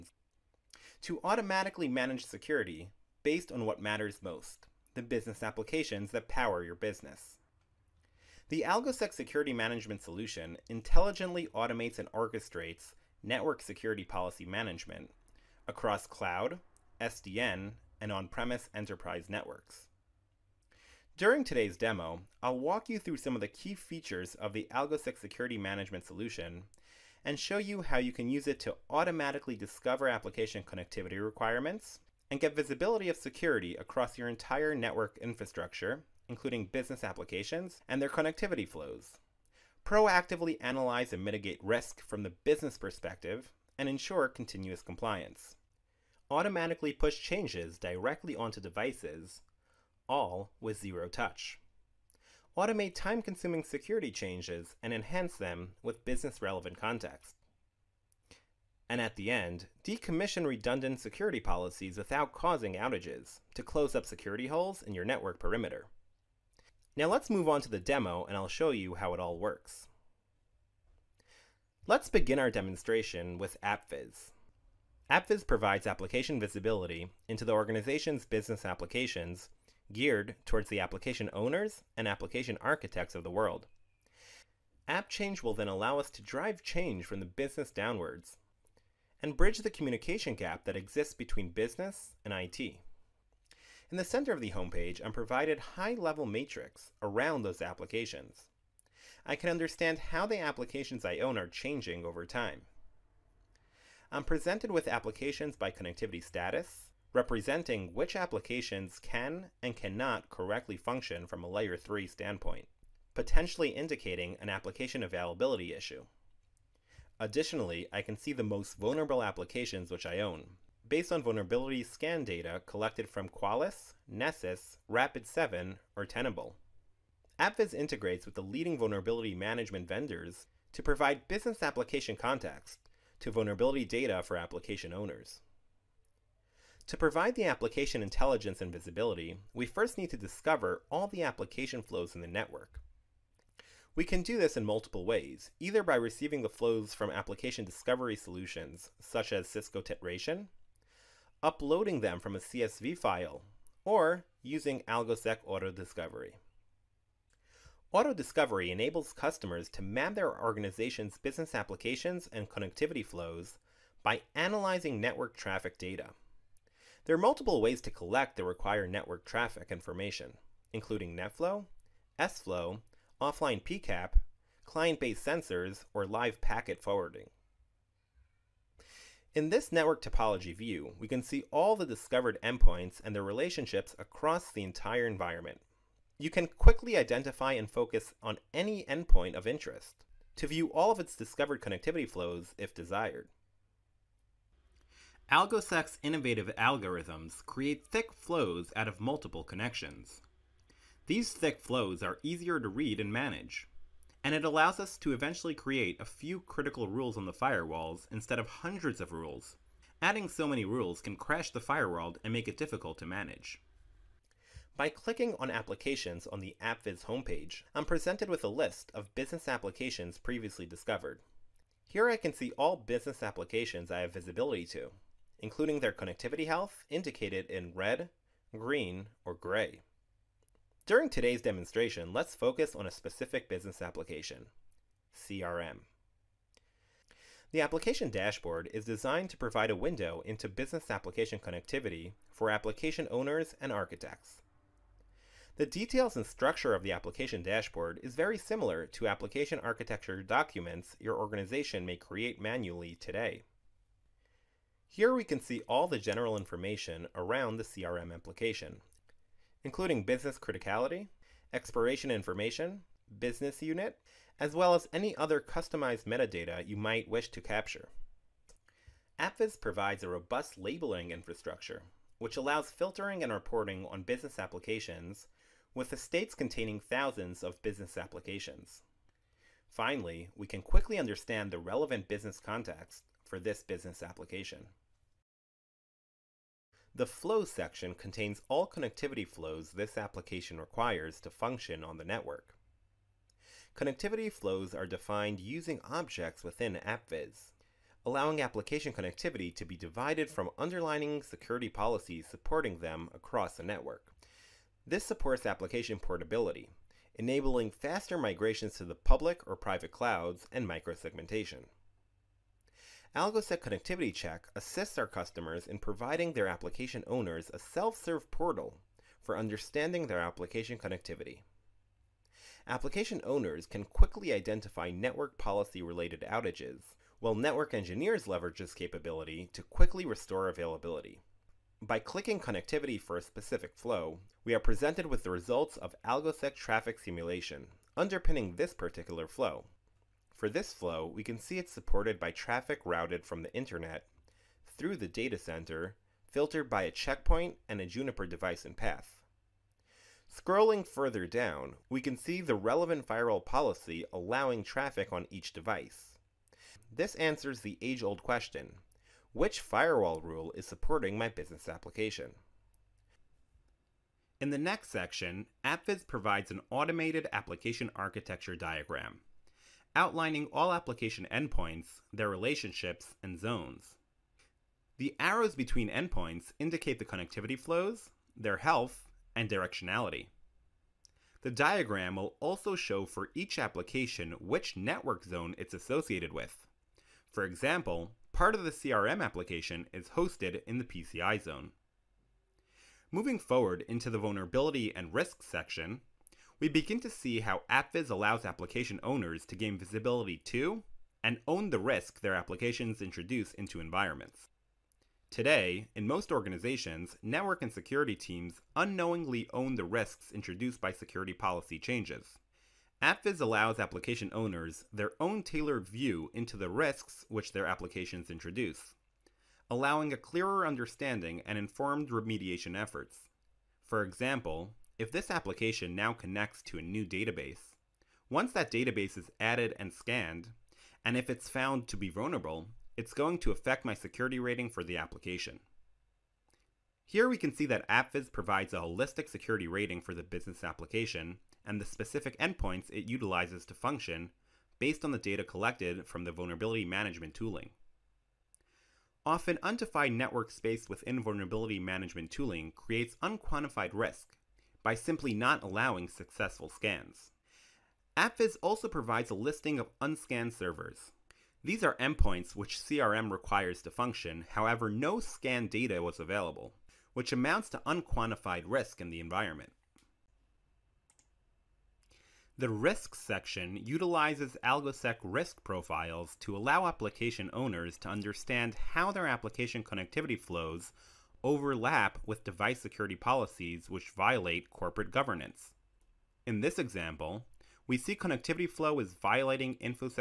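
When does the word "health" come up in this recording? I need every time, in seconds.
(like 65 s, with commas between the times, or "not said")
226 s, 378 s.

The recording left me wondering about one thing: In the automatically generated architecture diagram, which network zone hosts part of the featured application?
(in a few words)
PCI zone.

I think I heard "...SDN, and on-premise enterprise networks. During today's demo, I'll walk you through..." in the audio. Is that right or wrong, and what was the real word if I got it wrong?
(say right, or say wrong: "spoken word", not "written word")
right.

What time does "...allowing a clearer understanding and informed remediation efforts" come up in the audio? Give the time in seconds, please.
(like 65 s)
419 s.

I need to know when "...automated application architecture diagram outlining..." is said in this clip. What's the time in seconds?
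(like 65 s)
366 s.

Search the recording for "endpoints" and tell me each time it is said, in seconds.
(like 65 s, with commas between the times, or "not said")
182 s, 188 s, 371 s, 375 s, 442 s, 461 s.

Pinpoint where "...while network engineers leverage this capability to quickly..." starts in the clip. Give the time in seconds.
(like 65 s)
327 s.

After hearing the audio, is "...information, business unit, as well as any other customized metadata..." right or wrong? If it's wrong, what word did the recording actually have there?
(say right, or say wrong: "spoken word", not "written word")
right.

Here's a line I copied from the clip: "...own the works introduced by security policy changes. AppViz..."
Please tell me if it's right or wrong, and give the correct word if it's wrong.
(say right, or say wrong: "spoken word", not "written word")
wrong: "risks", not "works".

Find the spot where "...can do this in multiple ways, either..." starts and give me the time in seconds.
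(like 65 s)
144 s.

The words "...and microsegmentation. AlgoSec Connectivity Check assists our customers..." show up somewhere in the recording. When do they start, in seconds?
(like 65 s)
310 s.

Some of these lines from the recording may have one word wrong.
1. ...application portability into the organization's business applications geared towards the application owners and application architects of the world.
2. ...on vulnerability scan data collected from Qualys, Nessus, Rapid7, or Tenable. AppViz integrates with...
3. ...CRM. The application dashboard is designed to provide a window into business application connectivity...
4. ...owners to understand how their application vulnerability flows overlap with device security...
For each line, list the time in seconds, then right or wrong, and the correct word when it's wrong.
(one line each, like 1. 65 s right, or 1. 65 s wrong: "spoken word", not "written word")
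1. 75 s wrong: "visibility", not "portability"
2. 121 s right
3. 235 s right
4. 477 s wrong: "connectivity", not "vulnerability".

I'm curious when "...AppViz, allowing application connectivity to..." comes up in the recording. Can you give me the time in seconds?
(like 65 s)
296 s.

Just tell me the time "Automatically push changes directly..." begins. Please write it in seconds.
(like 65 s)
46 s.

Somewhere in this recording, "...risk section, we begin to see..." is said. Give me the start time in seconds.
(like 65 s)
395 s.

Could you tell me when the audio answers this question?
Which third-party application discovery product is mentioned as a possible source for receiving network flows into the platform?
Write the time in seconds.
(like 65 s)
149 s.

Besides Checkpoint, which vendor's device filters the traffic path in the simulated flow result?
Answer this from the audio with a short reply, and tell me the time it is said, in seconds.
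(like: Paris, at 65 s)
Juniper, at 347 s.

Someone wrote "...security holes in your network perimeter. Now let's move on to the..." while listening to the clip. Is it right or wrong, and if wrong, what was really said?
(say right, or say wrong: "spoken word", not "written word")
right.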